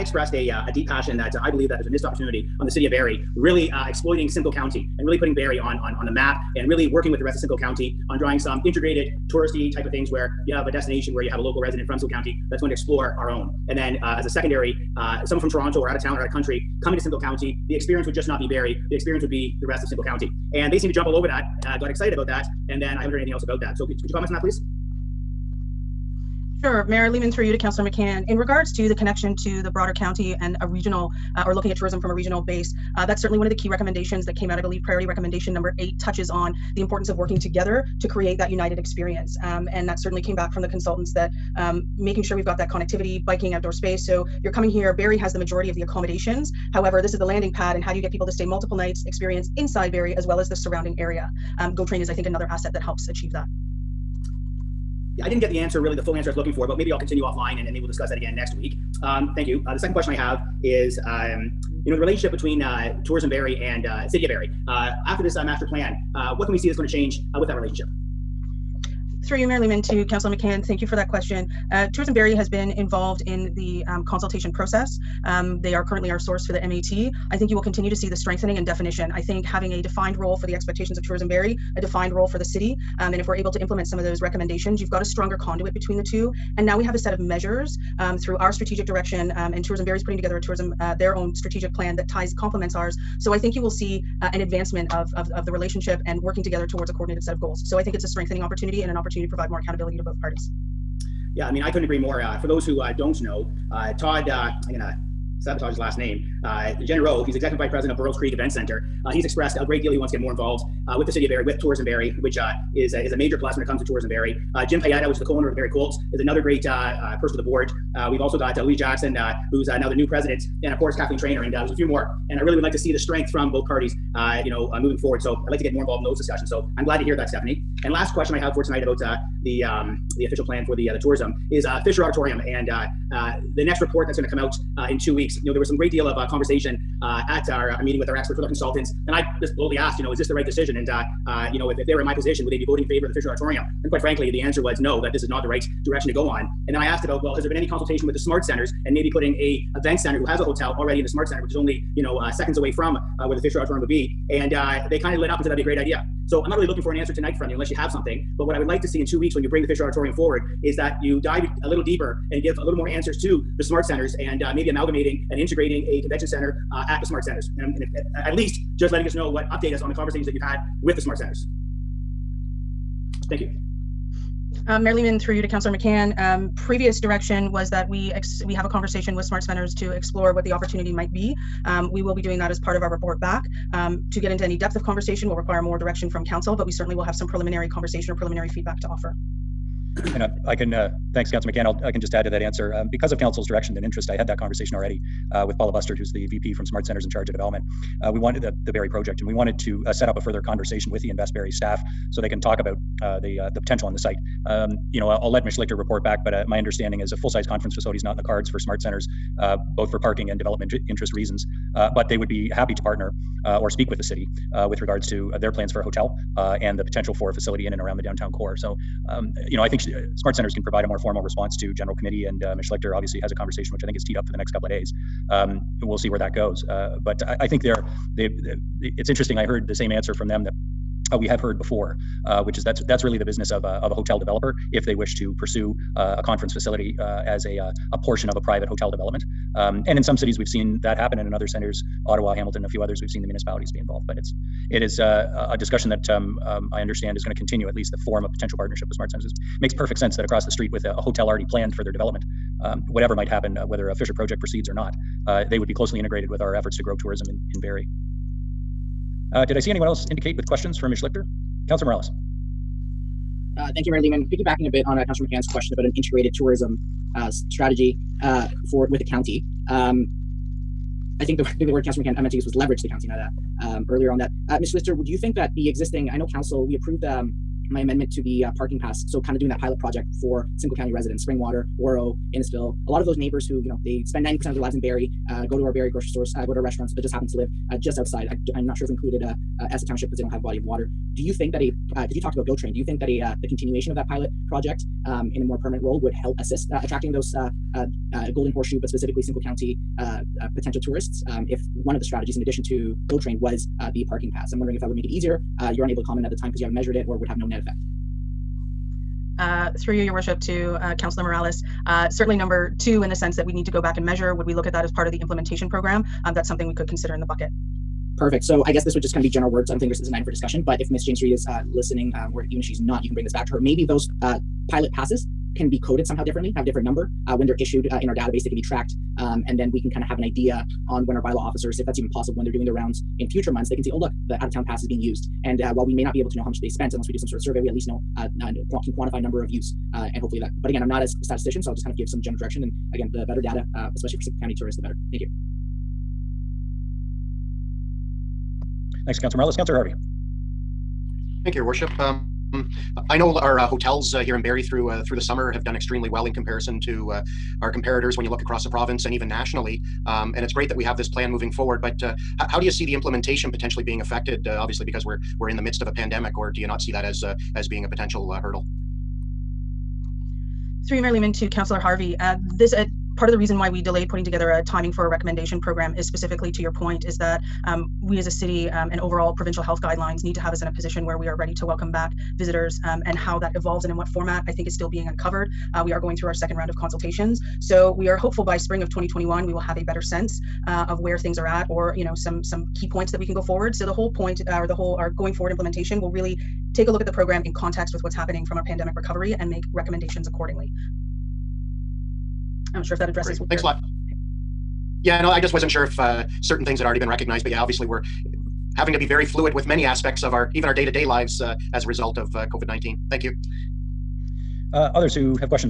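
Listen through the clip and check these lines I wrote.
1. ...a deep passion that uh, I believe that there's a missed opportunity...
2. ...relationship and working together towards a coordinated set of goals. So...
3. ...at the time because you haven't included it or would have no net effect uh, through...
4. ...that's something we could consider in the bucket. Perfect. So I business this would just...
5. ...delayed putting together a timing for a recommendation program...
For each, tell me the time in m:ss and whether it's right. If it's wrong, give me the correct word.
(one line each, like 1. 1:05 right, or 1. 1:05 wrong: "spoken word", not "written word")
1. 0:00 right
2. 1:35 right
3. 5:06 wrong: "measured", not "included"
4. 5:16 wrong: "guess", not "business"
5. 6:13 right.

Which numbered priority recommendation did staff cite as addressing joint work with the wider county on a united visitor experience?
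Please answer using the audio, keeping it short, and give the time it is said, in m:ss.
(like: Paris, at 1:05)
8, at 0:35.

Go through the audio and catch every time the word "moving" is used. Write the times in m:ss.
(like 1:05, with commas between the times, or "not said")
2:04, 6:01.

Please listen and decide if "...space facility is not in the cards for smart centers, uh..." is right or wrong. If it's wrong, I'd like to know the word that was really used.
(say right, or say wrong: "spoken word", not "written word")
wrong: "conference", not "space".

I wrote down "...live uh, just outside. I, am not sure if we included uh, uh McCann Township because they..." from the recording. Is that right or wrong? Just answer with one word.
wrong.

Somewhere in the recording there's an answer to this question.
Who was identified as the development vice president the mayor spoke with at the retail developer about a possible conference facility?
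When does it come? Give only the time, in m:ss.
3:15.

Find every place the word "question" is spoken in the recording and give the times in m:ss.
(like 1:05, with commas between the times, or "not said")
0:59, 1:11, 2:08, 4:20, 4:25.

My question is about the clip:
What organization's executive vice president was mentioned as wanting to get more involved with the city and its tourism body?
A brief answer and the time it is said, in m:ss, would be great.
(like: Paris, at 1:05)
Burl's Creek Event Center, at 1:47.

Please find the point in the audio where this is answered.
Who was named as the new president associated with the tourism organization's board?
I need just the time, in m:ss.
1:58.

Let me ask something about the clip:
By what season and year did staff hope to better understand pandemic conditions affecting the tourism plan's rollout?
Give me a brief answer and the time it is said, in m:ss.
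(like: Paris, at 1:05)
Spring 2021, at 6:28.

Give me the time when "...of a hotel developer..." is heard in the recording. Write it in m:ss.
3:53.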